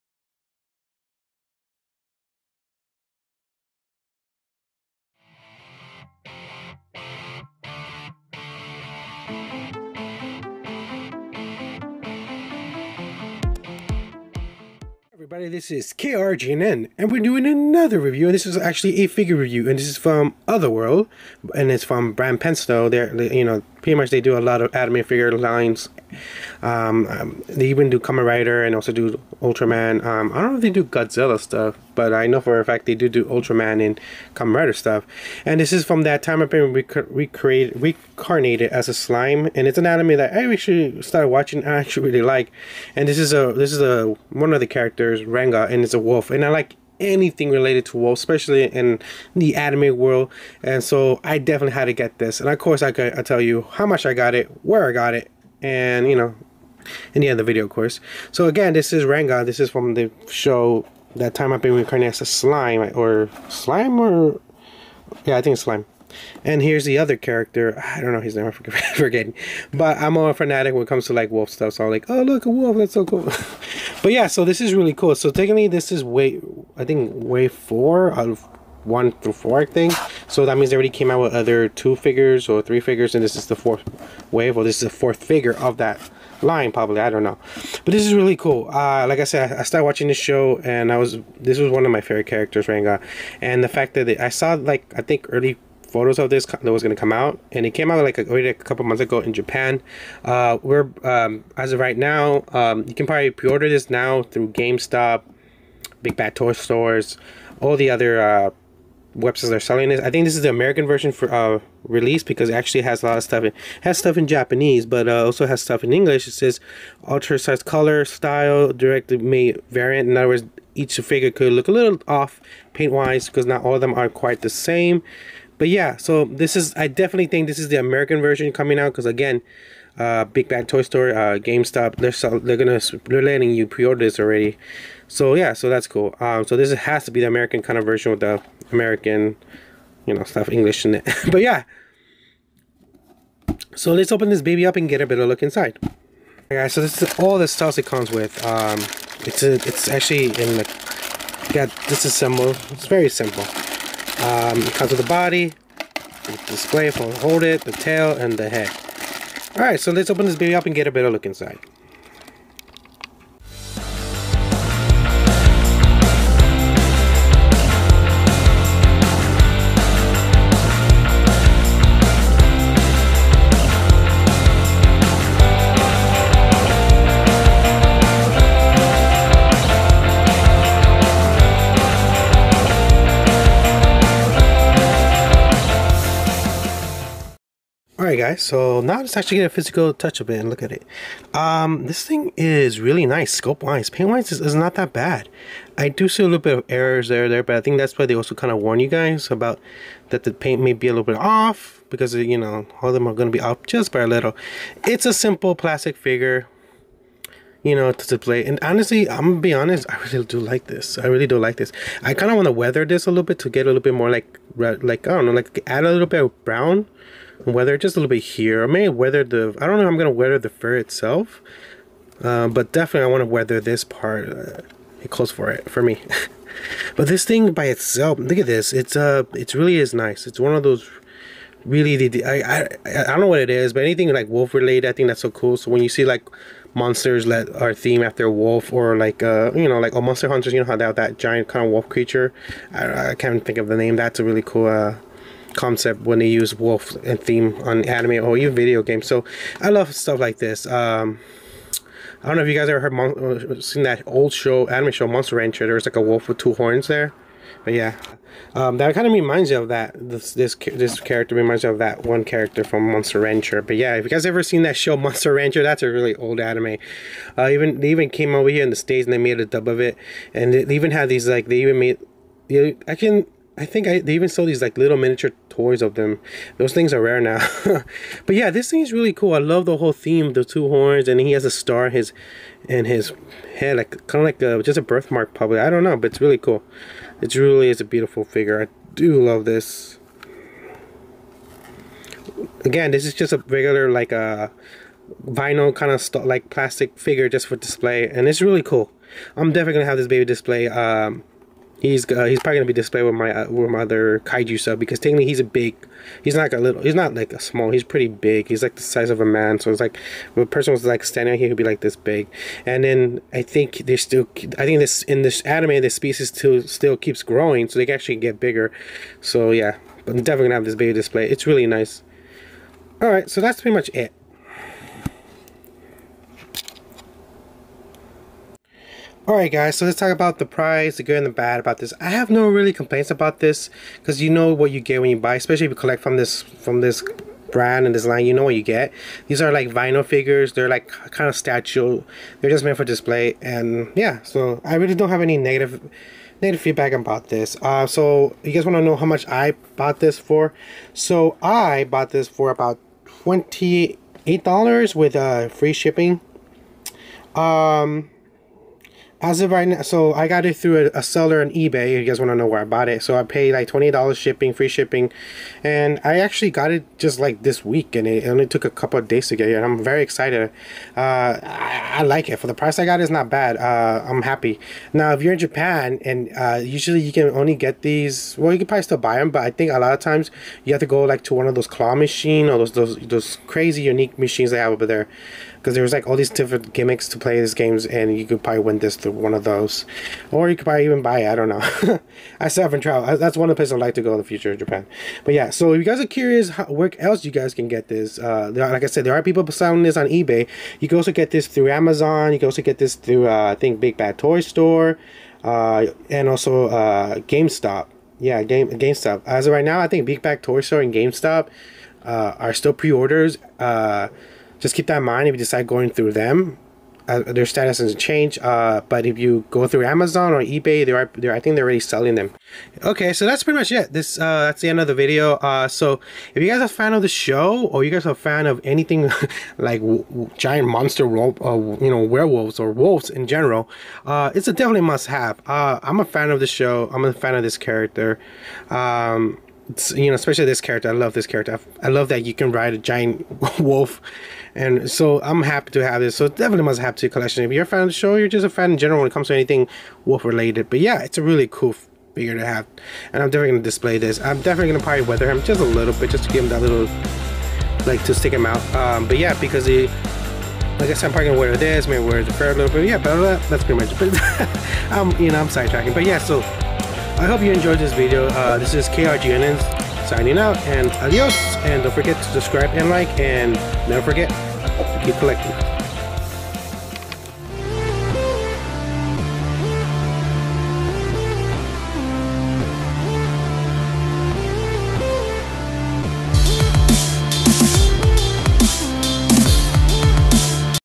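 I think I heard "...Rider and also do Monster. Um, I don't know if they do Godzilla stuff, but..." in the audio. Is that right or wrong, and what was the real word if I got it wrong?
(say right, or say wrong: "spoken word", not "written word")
wrong: "Ultraman", not "Monster".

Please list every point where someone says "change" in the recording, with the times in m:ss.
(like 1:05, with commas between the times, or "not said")
6:57.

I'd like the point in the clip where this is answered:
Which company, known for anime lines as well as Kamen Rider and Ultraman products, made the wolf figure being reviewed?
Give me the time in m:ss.
0:22.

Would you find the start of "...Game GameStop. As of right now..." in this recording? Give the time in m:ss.
6:48.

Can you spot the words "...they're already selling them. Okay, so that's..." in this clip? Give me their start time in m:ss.
7:01.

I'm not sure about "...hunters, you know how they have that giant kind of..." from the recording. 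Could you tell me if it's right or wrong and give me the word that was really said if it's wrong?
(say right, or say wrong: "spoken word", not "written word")
right.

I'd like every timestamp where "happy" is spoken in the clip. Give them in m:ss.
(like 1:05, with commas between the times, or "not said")
6:14, 7:25.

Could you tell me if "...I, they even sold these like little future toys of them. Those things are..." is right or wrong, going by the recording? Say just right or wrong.
wrong.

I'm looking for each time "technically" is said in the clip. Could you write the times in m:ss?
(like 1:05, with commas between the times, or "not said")
1:15, 5:04.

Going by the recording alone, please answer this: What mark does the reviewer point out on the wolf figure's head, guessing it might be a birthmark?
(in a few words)
A star.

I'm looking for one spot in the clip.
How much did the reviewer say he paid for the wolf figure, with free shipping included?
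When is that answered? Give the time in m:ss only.
5:53.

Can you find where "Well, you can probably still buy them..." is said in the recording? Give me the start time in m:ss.
6:18.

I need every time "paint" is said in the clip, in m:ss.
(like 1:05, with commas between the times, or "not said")
2:02, 3:13, 3:20.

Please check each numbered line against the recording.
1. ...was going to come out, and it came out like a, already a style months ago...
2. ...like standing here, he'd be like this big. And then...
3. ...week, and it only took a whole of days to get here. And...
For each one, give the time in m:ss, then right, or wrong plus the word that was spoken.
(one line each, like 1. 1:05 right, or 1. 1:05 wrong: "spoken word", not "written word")
1. 1:36 wrong: "couple", not "style"
2. 5:10 right
3. 6:07 wrong: "couple", not "whole".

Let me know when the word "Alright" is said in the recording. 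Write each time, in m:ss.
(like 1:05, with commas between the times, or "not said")
2:25, 2:39, 3:08, 5:29.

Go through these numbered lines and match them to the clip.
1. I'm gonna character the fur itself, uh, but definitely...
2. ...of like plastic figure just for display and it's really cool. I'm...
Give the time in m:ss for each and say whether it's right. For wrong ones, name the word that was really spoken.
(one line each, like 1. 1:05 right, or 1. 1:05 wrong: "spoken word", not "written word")
1. 3:39 wrong: "weather", not "character"
2. 4:55 right.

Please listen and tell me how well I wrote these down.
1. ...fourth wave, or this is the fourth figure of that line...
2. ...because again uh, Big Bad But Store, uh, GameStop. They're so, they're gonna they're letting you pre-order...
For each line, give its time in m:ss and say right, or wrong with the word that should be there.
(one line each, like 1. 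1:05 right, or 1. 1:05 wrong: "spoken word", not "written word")
1. 1:23 right
2. 2:08 wrong: "Toy", not "But".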